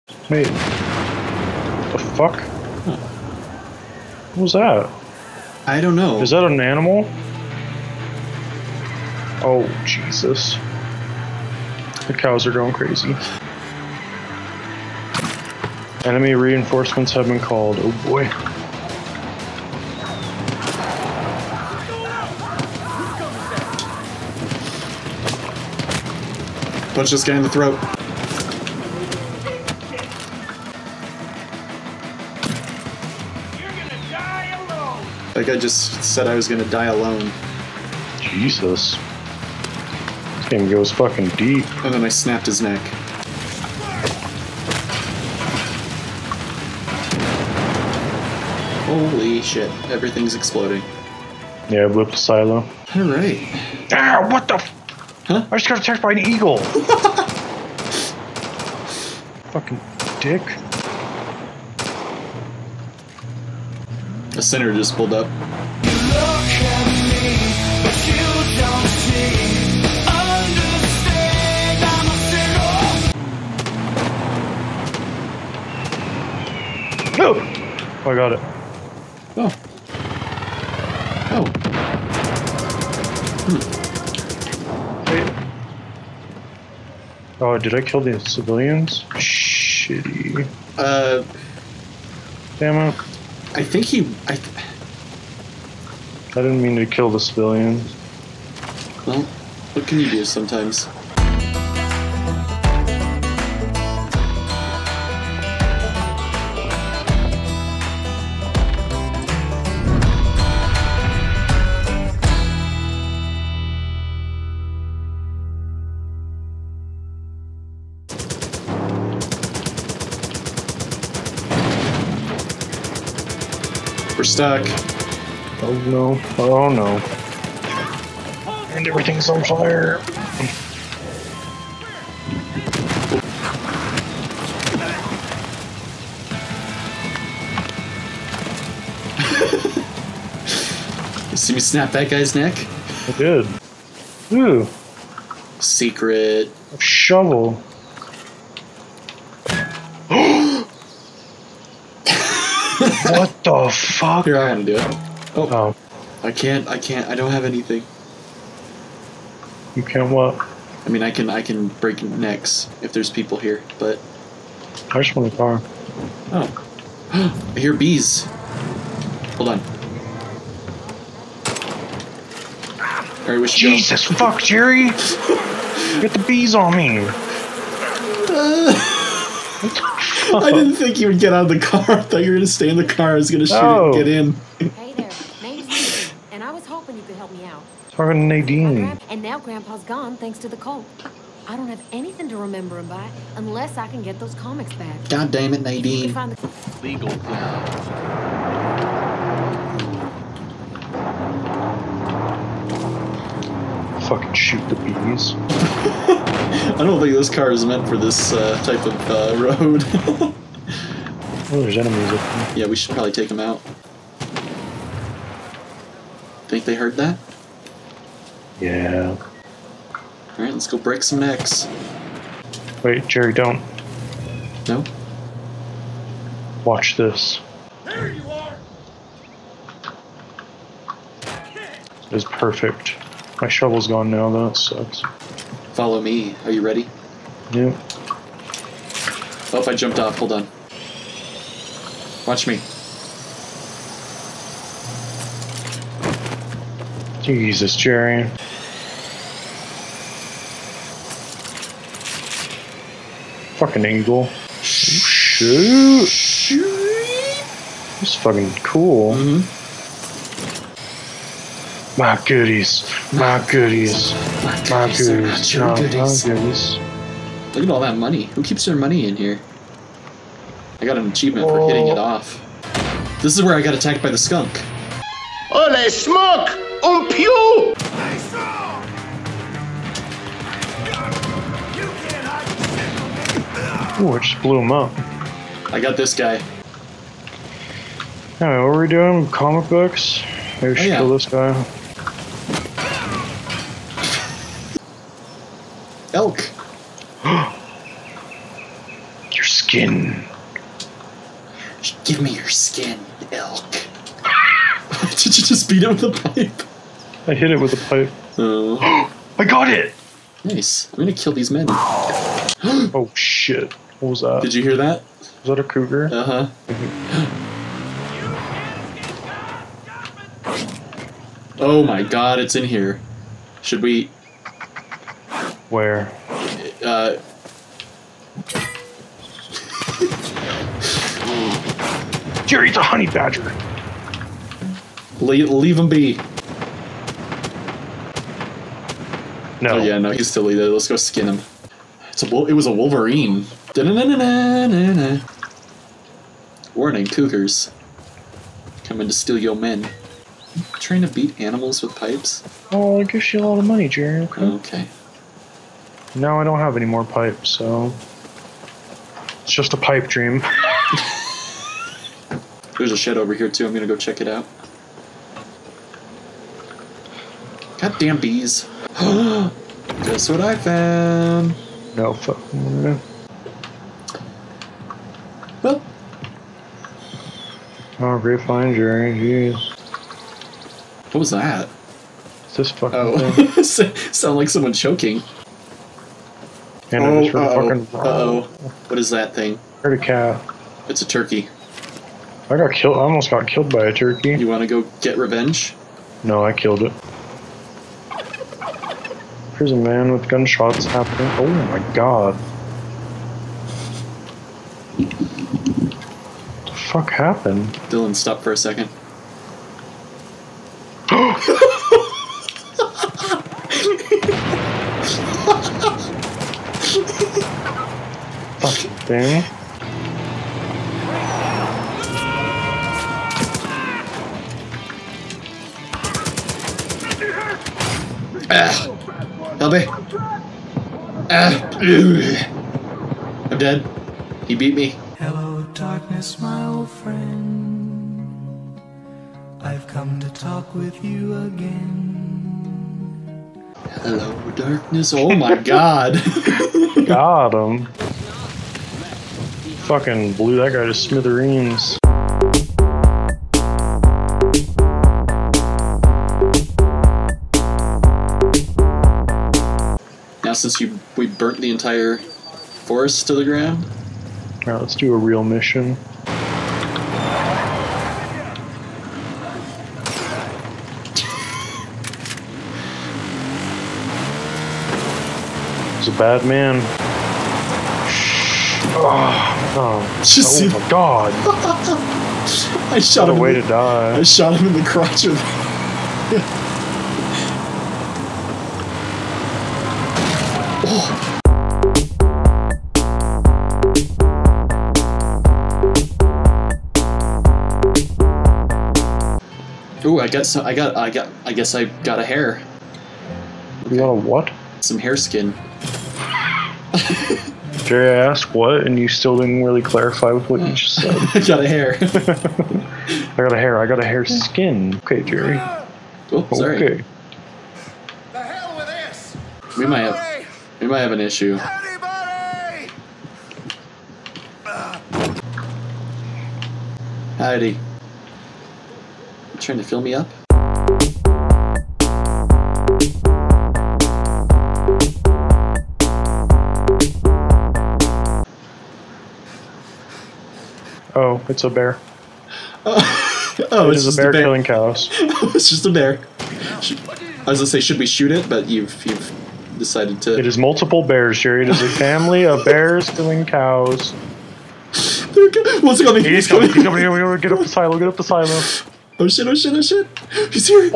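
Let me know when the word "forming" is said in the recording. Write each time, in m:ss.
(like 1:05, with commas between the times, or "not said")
not said.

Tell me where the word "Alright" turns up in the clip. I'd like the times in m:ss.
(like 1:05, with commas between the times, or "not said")
0:52, 3:40.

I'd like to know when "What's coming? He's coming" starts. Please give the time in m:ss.
9:15.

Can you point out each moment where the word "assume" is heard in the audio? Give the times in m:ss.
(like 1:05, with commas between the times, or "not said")
6:59.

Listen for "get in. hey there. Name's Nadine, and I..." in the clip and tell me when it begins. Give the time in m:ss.
3:03.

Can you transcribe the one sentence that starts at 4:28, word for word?
Who keeps their money in here?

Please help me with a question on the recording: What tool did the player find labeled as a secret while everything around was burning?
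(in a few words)
A shovel.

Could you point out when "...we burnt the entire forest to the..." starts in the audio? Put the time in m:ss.
7:41.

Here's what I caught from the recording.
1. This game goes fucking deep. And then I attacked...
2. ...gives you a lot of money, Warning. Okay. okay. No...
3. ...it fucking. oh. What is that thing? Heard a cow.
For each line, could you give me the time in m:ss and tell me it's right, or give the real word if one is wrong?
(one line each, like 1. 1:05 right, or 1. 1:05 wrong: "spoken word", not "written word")
1. 0:40 wrong: "snapped", not "attacked"
2. 5:53 wrong: "Jerry", not "Warning"
3. 6:27 right.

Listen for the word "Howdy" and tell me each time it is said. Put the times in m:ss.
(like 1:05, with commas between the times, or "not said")
8:47.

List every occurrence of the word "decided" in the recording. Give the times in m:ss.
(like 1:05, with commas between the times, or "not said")
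9:09.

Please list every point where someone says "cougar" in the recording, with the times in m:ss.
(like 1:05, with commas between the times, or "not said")
5:15, 5:47.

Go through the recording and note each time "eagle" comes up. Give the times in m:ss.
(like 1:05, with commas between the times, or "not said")
0:56, 4:13.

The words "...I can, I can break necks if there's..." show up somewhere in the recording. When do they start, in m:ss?
2:41.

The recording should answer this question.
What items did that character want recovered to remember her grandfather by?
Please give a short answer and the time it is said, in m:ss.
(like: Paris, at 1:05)
Comics, at 3:13.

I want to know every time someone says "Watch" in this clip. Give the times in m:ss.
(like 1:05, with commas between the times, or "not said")
3:46, 4:02.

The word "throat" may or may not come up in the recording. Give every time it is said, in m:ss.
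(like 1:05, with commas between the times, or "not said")
0:27.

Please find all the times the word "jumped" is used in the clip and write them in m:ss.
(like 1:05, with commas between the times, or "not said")
3:59.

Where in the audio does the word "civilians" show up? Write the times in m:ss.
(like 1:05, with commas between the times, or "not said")
1:28, 1:37.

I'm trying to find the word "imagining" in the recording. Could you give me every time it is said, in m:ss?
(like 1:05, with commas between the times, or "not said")
not said.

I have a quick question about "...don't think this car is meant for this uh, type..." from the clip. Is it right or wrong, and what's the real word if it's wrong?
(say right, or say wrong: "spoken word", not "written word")
right.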